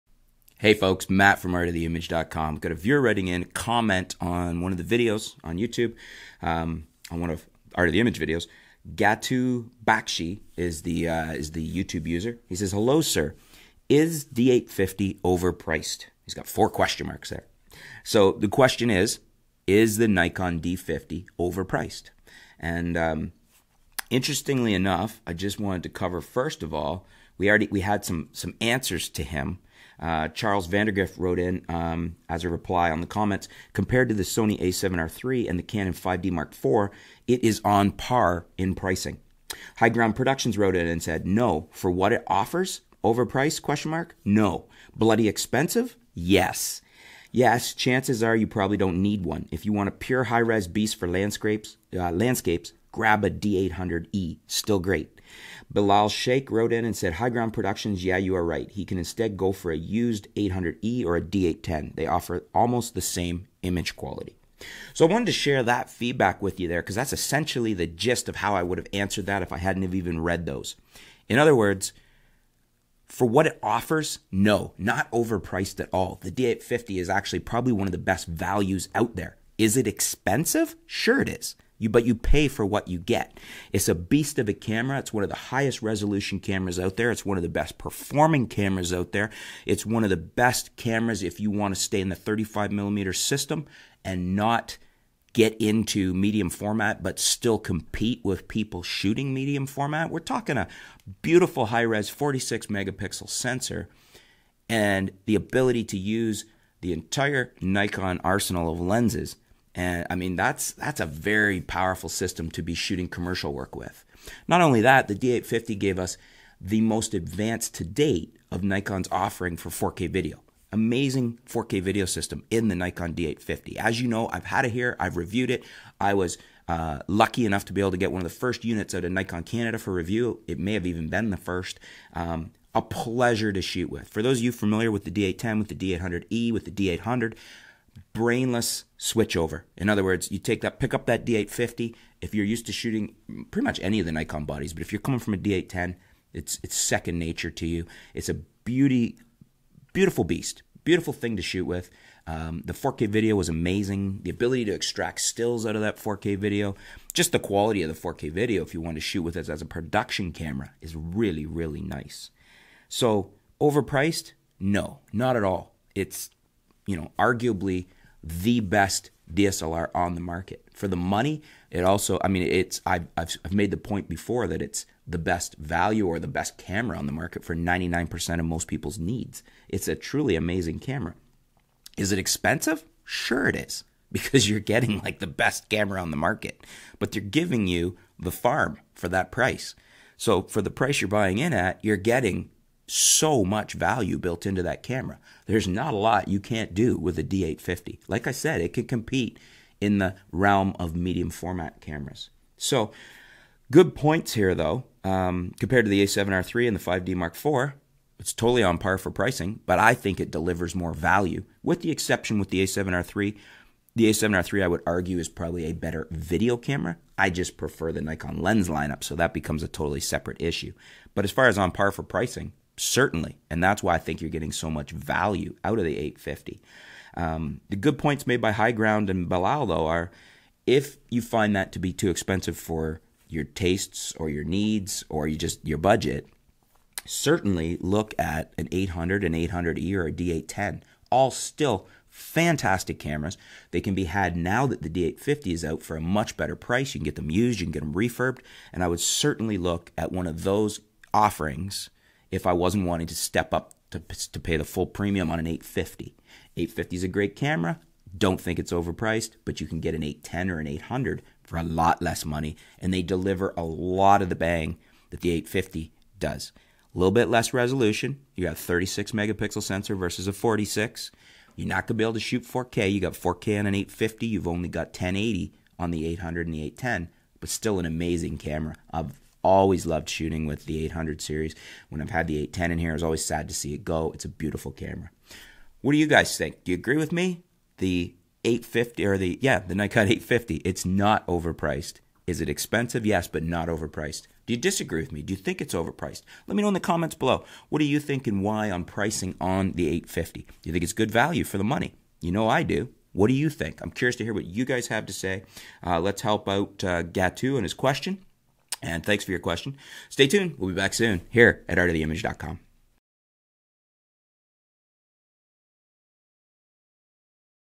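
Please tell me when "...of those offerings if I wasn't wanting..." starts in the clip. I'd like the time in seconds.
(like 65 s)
250 s.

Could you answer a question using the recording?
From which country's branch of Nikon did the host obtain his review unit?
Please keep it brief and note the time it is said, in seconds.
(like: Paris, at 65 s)
Canada, at 129 s.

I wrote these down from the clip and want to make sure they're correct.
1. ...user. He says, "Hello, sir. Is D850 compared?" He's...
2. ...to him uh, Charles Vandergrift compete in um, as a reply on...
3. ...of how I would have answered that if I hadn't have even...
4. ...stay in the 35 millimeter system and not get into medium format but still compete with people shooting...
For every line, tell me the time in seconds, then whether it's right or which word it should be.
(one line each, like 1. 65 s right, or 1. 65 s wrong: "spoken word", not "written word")
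1. 12 s wrong: "overpriced", not "compared"
2. 29 s wrong: "wrote", not "compete"
3. 68 s right
4. 91 s right.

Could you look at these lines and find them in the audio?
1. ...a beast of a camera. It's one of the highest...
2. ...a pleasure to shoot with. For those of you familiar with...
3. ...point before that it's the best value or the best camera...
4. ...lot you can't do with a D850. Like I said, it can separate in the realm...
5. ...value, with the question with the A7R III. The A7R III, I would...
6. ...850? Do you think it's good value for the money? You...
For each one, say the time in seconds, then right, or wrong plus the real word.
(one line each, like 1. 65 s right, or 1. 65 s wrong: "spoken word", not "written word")
1. 83 s right
2. 132 s right
3. 173 s right
4. 195 s wrong: "compete", not "separate"
5. 210 s wrong: "exception", not "question"
6. 299 s right.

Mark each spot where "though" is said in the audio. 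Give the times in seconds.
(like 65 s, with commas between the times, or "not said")
204 s, 229 s.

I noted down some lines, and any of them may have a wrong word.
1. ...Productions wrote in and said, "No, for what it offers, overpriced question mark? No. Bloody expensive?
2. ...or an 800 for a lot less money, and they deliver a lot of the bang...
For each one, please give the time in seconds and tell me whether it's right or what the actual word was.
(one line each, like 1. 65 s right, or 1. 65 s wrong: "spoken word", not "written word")
1. 40 s right
2. 260 s right.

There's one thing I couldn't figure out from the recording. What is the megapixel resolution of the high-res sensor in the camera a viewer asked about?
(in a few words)
46.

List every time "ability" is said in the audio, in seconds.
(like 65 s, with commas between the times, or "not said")
105 s, 154 s.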